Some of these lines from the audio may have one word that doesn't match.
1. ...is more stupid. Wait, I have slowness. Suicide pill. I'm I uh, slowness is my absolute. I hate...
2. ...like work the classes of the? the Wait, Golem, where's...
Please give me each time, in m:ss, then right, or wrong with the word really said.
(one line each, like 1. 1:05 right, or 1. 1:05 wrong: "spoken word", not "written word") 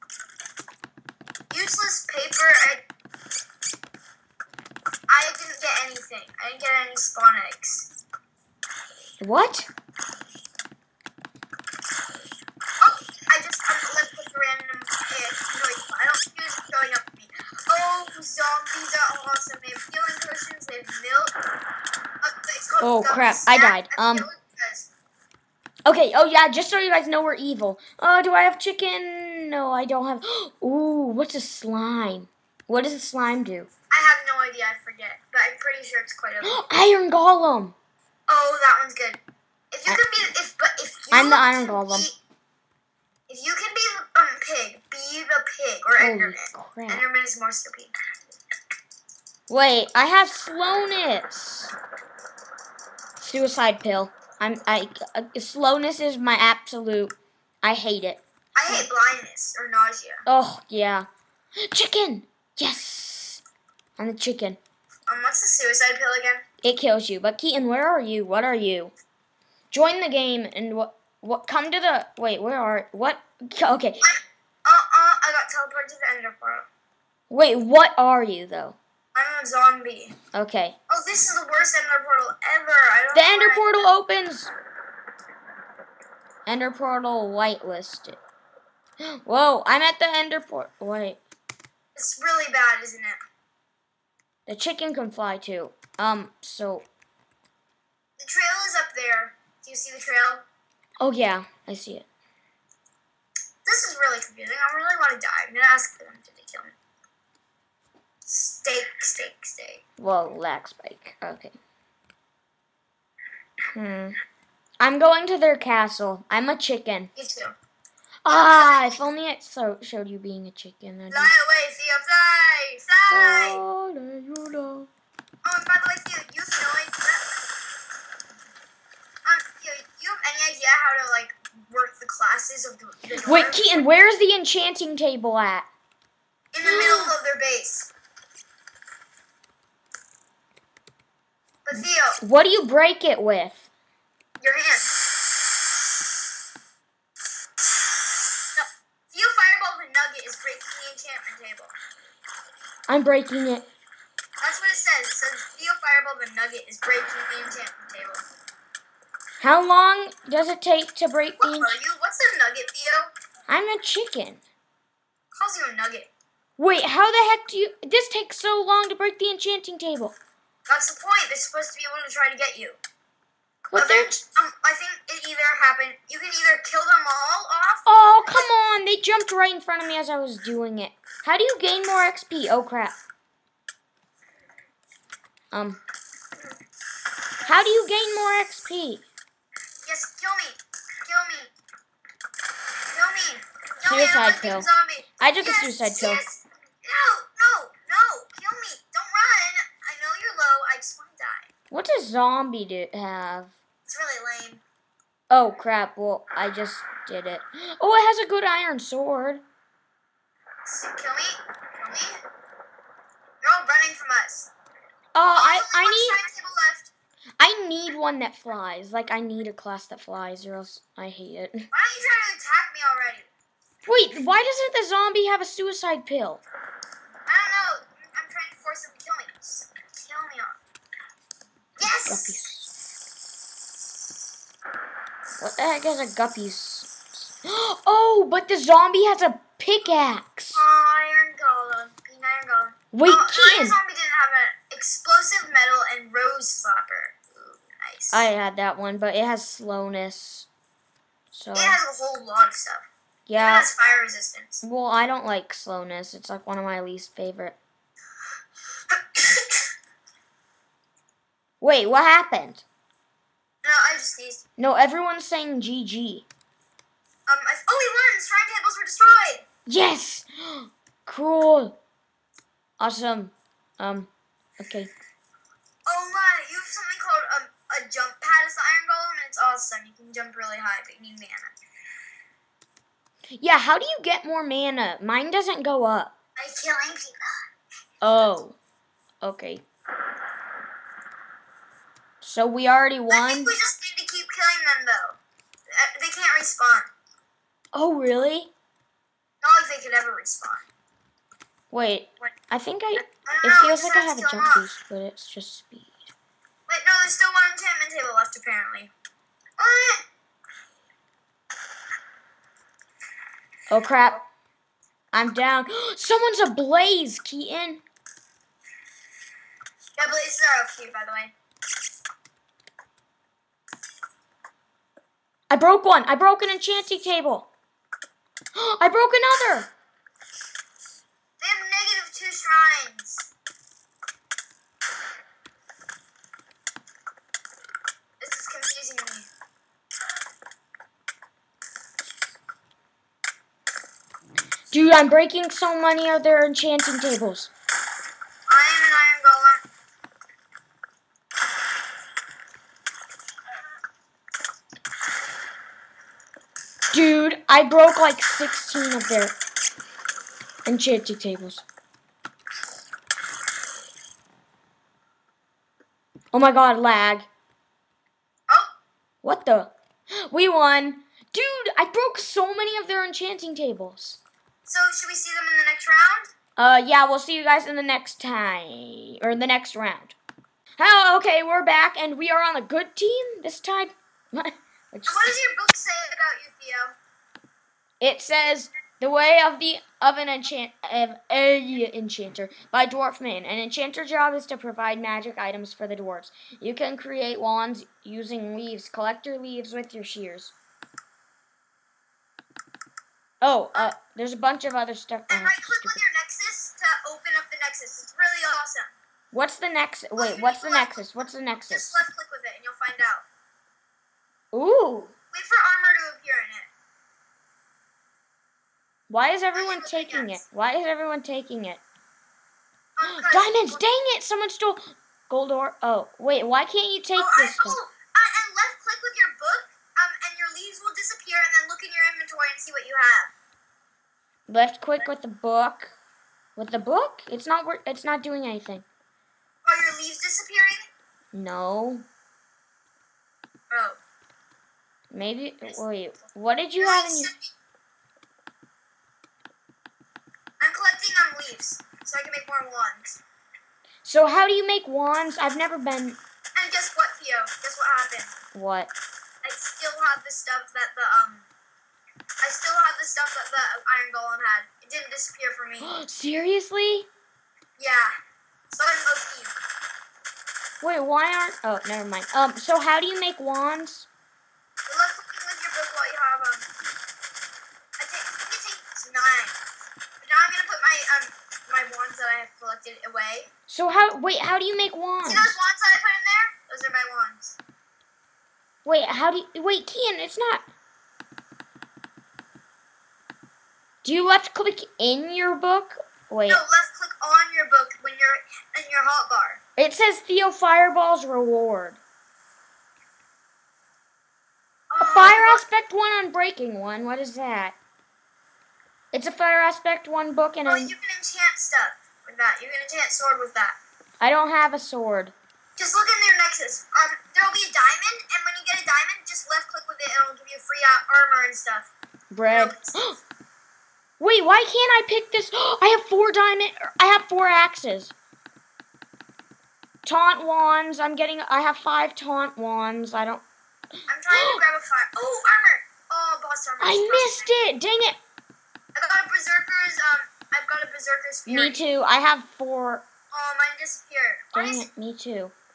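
1. 0:47 right
2. 2:11 wrong: "Keaton", not "Golem".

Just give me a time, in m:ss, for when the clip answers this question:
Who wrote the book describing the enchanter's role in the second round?
6:32.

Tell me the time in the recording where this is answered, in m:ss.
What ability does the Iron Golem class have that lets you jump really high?
4:37.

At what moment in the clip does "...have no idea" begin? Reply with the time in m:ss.
0:34.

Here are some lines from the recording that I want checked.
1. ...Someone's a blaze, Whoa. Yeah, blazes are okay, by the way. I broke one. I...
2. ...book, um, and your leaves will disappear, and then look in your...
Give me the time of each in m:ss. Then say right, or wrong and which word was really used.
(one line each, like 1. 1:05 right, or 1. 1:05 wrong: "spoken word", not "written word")
1. 5:15 wrong: "Keaton", not "Whoa"
2. 7:09 right.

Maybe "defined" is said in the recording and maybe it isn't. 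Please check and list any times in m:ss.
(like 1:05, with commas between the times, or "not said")
not said.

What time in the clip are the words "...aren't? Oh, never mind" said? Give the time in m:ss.
7:51.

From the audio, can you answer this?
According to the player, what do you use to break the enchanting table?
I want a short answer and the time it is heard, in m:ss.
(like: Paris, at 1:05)
Your hand, at 2:24.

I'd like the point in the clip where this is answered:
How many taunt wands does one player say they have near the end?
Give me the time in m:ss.
8:51.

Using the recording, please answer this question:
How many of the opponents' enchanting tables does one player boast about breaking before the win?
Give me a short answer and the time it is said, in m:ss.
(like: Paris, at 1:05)
16, at 5:58.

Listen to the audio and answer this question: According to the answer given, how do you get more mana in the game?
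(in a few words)
By killing people.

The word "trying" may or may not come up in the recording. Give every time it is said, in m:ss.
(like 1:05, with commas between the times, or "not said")
3:42, 3:48, 8:54.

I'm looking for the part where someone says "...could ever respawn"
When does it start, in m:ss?
4:59.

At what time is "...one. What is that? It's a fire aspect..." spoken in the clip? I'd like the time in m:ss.
8:26.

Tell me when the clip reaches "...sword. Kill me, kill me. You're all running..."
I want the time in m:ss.
3:28.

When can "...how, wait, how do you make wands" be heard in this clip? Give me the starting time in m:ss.
8:03.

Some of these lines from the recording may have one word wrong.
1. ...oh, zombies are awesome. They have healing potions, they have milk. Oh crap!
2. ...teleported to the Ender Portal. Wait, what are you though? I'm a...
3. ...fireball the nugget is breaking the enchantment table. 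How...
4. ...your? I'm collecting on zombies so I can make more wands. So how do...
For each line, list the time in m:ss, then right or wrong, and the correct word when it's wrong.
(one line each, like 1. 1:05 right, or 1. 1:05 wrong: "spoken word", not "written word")
1. 0:17 right
2. 1:15 right
3. 2:35 right
4. 7:27 wrong: "leaves", not "zombies".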